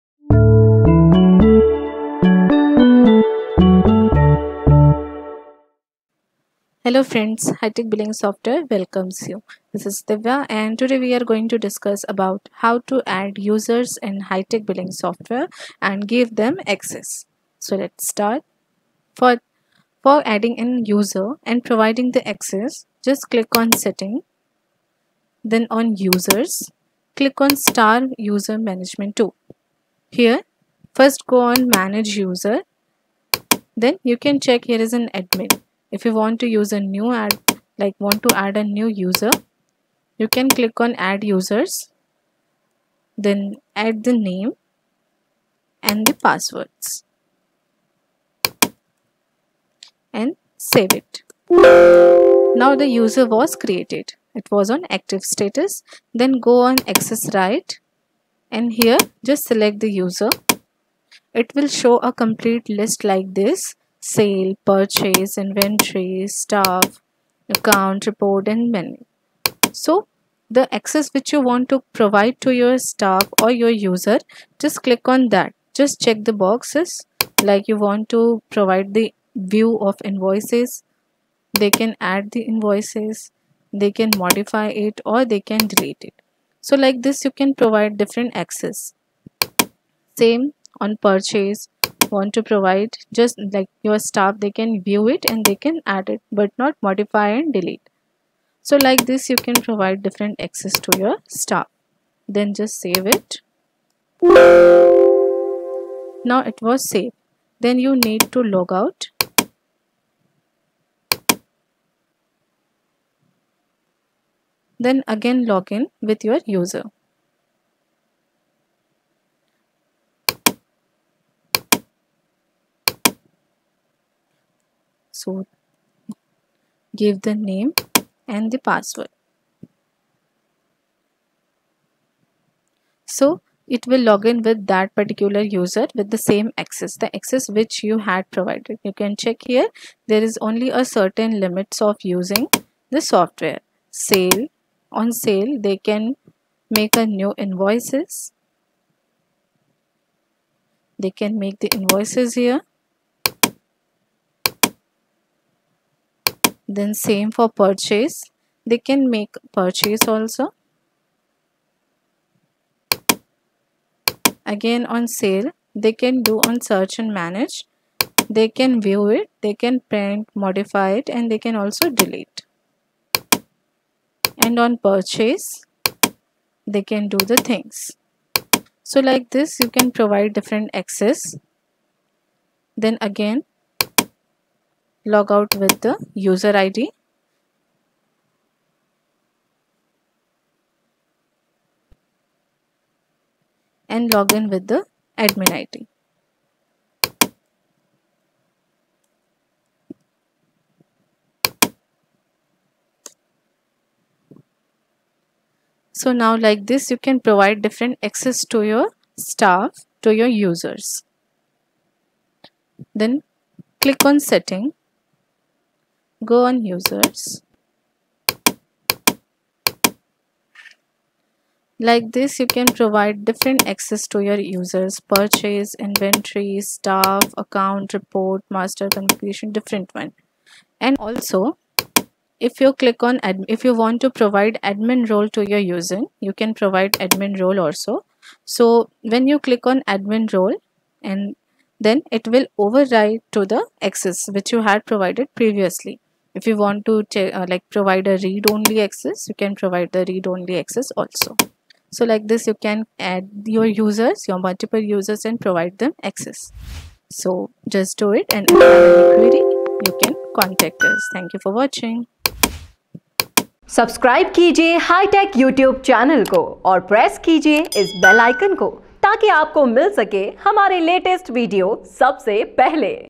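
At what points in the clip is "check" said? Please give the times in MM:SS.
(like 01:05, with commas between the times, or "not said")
00:34, 01:16, 02:19.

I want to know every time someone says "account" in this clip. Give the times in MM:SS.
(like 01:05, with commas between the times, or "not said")
01:07, 03:47.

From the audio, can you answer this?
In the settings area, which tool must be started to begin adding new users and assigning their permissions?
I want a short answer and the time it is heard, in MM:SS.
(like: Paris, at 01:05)
User management tool, at 00:28.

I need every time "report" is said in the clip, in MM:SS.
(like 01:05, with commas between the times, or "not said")
01:08, 03:47.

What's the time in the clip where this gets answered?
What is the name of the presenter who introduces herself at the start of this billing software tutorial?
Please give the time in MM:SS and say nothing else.
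00:10.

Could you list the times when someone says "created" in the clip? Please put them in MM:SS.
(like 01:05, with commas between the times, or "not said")
00:53.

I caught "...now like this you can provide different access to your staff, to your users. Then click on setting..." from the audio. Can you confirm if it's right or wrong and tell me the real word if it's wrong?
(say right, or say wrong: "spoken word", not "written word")
right.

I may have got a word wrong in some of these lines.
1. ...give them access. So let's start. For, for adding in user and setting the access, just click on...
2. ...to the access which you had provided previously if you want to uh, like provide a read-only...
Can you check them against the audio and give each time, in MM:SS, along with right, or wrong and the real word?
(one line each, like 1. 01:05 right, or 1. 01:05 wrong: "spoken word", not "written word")
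1. 00:16 wrong: "providing", not "setting"
2. 04:03 right.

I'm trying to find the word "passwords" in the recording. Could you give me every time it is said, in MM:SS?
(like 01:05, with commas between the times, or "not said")
00:46, 02:08.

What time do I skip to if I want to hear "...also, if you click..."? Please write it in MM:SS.
03:50.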